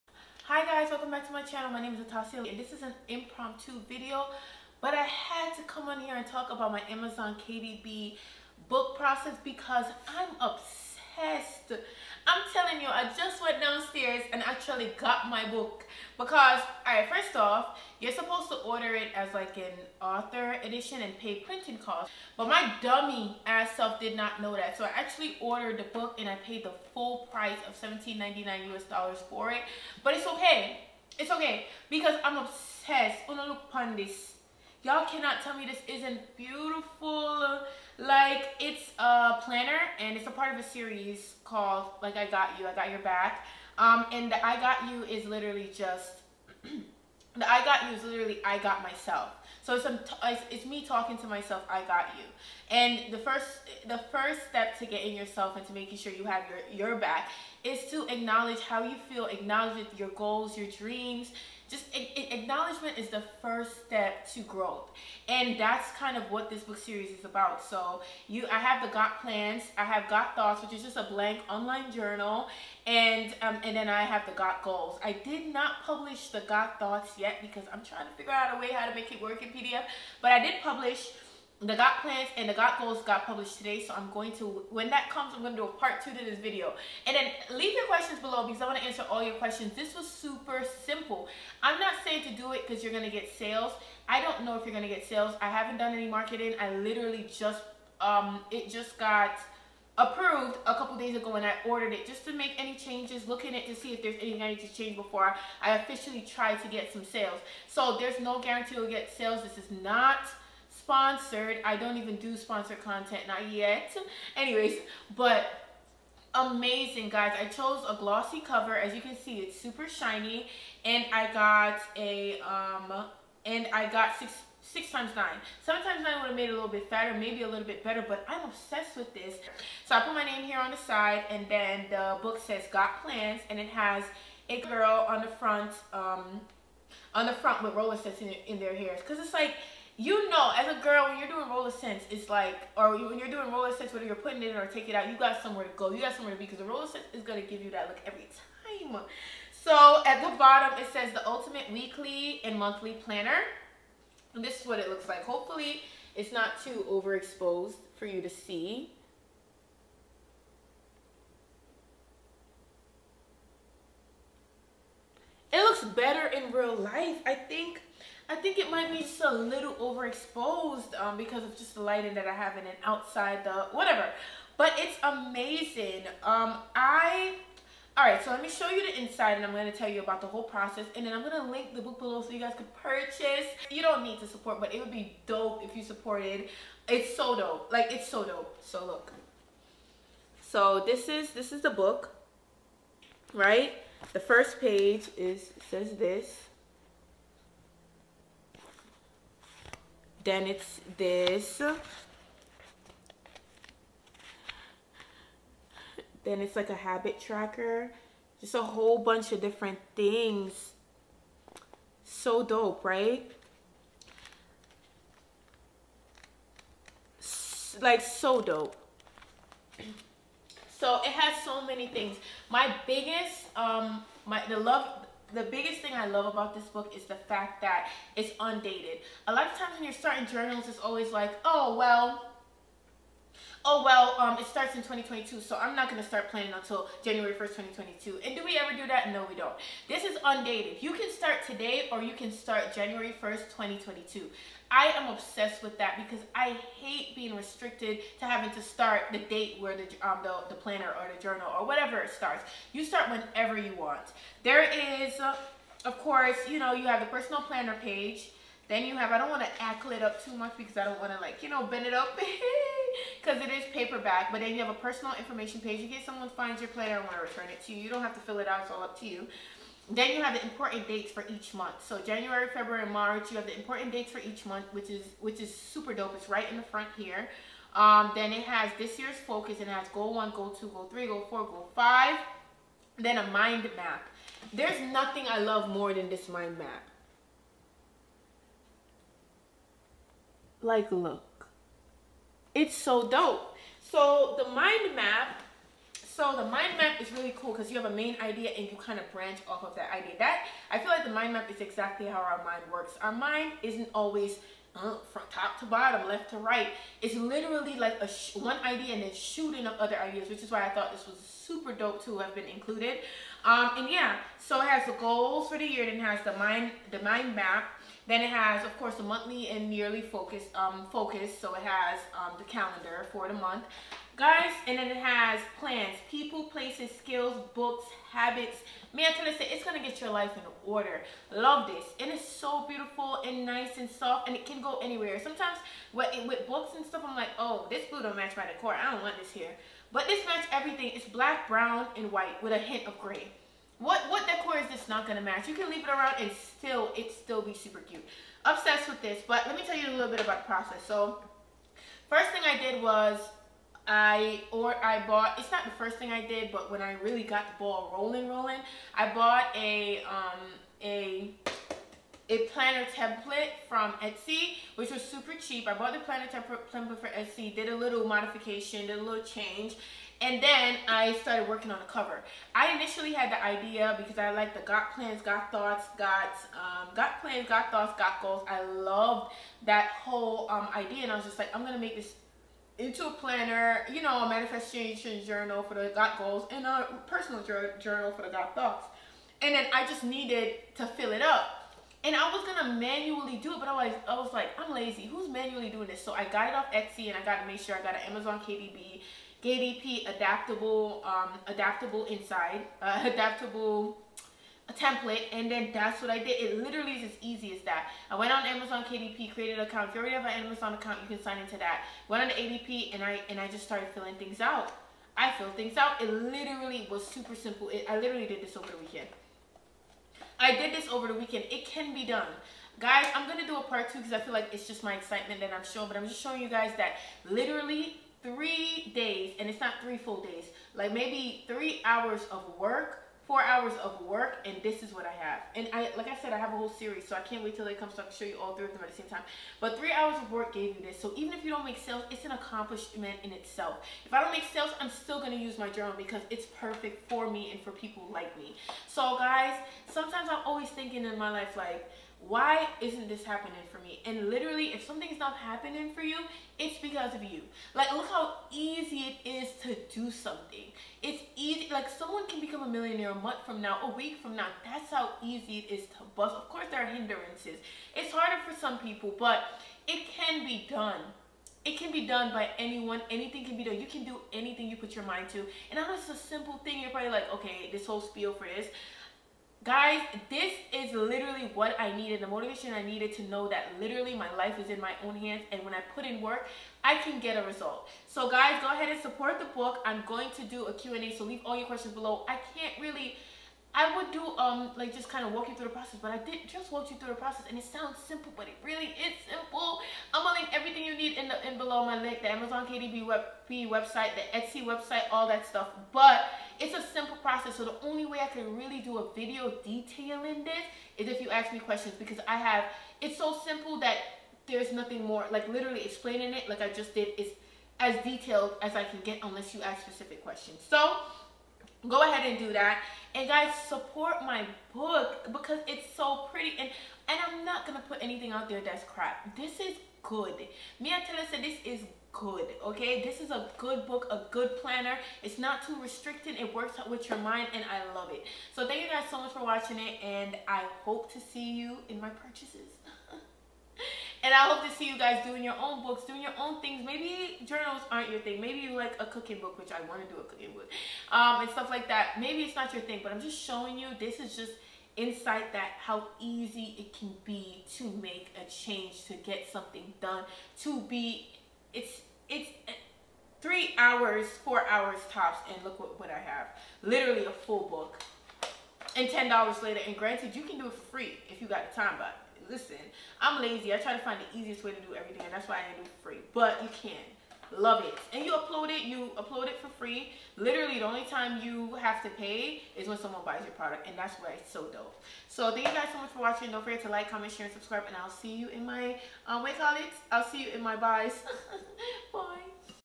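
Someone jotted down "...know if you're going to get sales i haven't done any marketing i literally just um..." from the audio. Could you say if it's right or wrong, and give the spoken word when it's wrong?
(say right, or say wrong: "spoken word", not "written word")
right.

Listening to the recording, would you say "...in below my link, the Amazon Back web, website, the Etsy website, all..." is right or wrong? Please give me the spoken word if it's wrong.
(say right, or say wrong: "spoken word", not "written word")
wrong: "KDP", not "Back".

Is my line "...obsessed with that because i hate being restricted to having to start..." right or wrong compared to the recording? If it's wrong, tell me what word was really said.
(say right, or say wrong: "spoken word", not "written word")
right.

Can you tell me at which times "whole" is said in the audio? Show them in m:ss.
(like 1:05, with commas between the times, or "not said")
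3:00, 3:28, 6:19, 7:16, 7:57.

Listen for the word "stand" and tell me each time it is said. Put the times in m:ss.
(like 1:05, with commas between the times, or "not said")
not said.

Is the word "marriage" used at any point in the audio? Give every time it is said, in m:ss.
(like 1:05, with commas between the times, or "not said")
not said.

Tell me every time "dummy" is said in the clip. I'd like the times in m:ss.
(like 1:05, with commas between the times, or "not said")
0:22.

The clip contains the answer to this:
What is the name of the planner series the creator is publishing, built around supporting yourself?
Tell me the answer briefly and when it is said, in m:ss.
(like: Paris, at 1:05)
I Got Your Back, at 0:42.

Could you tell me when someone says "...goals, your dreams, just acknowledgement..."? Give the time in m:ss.
1:00.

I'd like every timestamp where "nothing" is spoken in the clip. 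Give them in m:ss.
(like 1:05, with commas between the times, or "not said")
4:44, 8:34.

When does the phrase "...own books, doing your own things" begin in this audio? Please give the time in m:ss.
9:05.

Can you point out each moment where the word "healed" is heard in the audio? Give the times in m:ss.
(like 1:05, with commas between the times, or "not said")
not said.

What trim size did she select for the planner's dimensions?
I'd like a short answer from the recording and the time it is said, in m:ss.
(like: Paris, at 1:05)
6 x 9, at 2:04.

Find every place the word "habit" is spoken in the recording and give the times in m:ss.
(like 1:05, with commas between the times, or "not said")
3:26, 5:28.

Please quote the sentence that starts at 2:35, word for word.
Hopefully, it's not too overexposed for you to see.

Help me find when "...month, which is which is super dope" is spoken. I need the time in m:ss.
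4:34.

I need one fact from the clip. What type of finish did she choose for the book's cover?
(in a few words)
Glossy.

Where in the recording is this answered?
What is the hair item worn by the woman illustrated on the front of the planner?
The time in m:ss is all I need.
2:17.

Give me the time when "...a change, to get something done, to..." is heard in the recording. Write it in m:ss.
9:18.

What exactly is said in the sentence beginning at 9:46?
Don't forget to like, comment, share, and subscribe, and I'll see you in my, uh, wait, call it?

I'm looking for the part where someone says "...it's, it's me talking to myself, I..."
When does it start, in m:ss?
0:49.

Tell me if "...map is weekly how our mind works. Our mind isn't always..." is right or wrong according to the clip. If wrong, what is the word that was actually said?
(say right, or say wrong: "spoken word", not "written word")
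wrong: "exactly", not "weekly".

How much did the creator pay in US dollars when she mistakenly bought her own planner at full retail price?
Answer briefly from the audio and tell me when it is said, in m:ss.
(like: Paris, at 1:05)
$17.99, at 0:27.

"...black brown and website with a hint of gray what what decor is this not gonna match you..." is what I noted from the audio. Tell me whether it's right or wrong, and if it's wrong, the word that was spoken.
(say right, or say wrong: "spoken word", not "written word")
wrong: "white", not "website".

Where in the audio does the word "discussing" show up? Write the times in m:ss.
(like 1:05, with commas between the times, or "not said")
not said.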